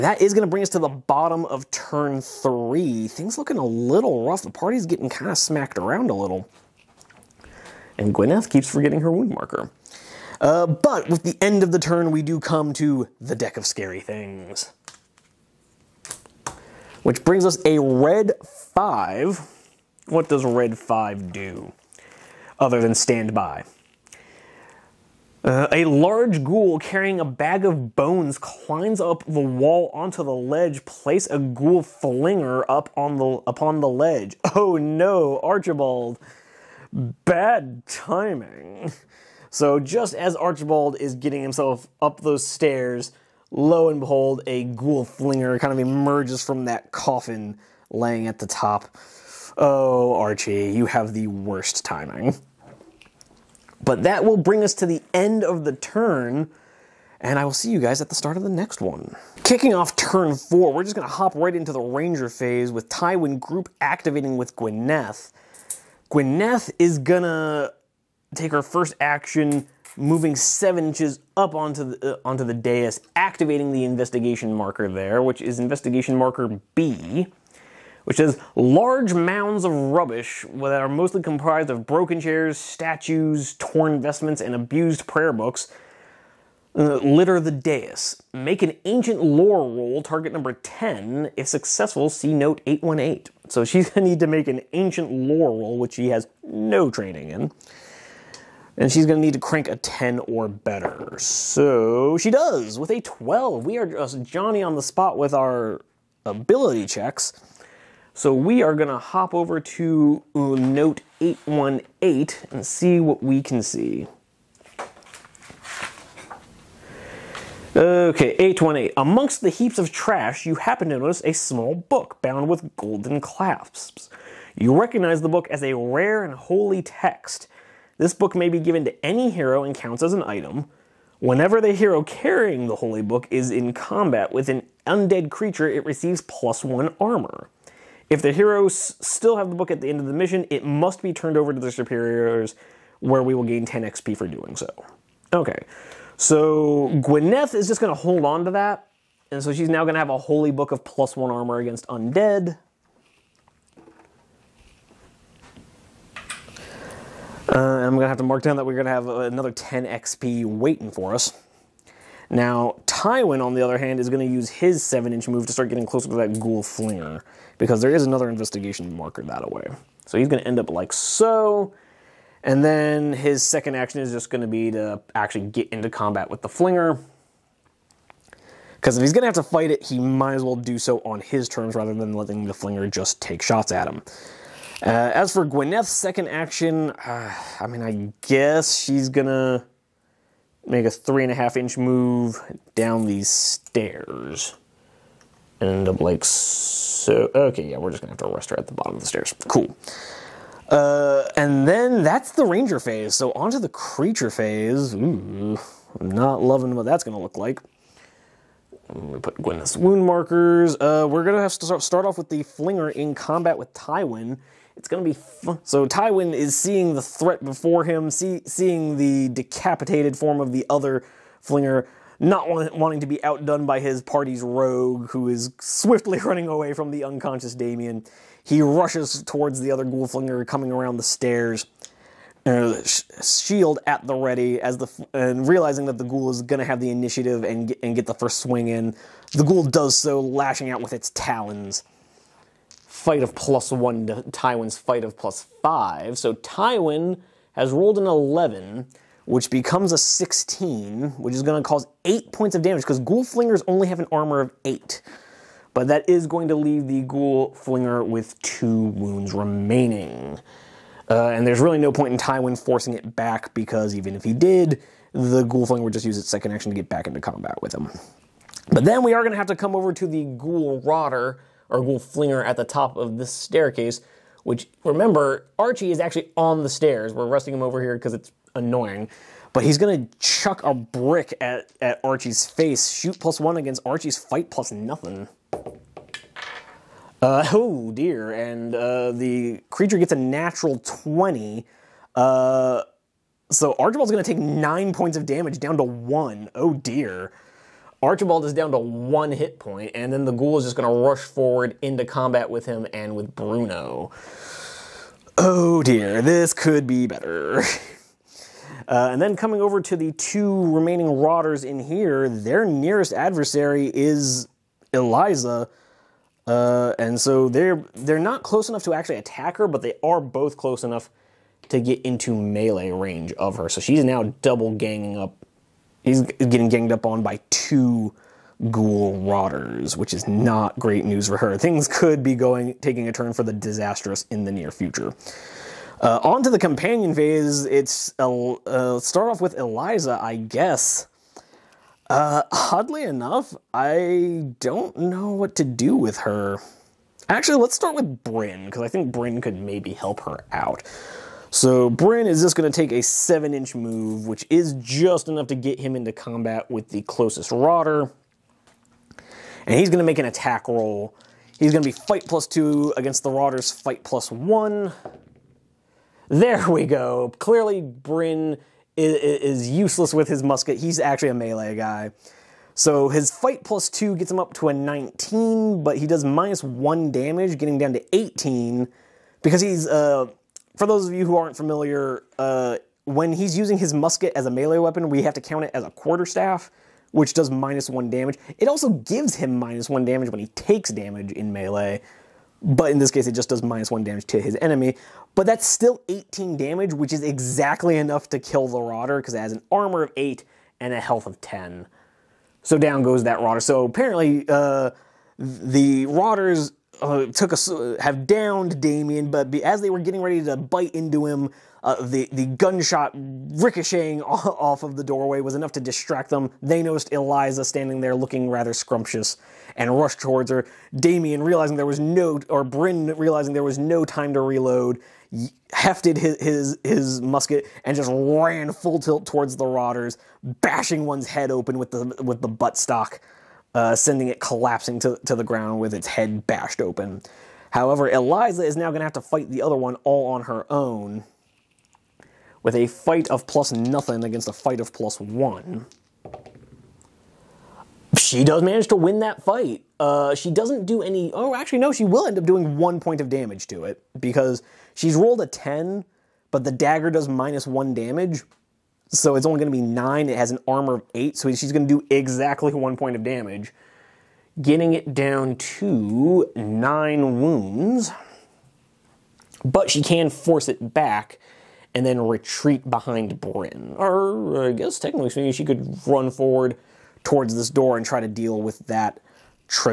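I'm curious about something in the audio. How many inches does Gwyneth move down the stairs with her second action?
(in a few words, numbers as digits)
3.5 inches.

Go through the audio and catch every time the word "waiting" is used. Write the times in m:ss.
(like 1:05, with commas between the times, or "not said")
2:40.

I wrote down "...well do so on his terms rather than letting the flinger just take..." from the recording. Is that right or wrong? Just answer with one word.
right.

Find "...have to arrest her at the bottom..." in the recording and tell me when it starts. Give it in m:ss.
3:18.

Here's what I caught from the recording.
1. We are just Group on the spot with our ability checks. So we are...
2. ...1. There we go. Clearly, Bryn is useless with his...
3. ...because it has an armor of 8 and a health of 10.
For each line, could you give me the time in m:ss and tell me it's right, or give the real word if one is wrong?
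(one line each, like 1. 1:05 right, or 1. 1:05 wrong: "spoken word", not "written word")
1. 1:43 wrong: "Johnny", not "Group"
2. 6:04 right
3. 6:39 right.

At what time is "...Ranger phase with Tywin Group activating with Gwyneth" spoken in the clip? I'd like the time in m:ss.
1:01.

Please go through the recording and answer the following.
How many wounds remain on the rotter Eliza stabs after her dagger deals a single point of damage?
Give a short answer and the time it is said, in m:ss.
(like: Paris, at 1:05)
9, at 7:46.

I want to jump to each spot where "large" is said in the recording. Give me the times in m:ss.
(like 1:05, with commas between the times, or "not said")
0:25, 1:18.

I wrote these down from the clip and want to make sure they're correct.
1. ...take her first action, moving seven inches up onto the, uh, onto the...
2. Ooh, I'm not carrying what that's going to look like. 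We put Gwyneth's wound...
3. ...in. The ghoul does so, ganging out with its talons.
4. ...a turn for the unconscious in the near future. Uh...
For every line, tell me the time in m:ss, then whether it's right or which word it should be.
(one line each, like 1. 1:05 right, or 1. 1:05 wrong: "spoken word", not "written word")
1. 1:08 right
2. 3:24 wrong: "loving", not "carrying"
3. 3:58 wrong: "lashing", not "ganging"
4. 5:33 wrong: "disastrous", not "unconscious".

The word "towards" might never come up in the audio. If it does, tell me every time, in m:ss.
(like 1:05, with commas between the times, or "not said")
3:49, 7:00, 7:09, 7:57.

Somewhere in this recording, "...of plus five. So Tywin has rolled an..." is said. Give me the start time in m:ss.
4:05.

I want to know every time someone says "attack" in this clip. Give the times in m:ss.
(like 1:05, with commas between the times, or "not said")
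5:19, 6:00.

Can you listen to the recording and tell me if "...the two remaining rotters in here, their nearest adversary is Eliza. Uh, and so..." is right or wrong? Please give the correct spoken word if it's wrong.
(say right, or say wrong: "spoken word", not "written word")
right.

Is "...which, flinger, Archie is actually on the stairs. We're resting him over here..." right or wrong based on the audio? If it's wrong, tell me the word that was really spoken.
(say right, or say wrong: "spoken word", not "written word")
wrong: "remember", not "flinger".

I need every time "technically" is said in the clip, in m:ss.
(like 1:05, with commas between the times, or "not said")
7:54.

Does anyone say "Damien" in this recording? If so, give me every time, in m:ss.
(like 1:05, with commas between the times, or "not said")
3:47, 6:48, 7:00.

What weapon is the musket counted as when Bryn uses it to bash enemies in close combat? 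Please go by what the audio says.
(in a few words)
Quarterstaff.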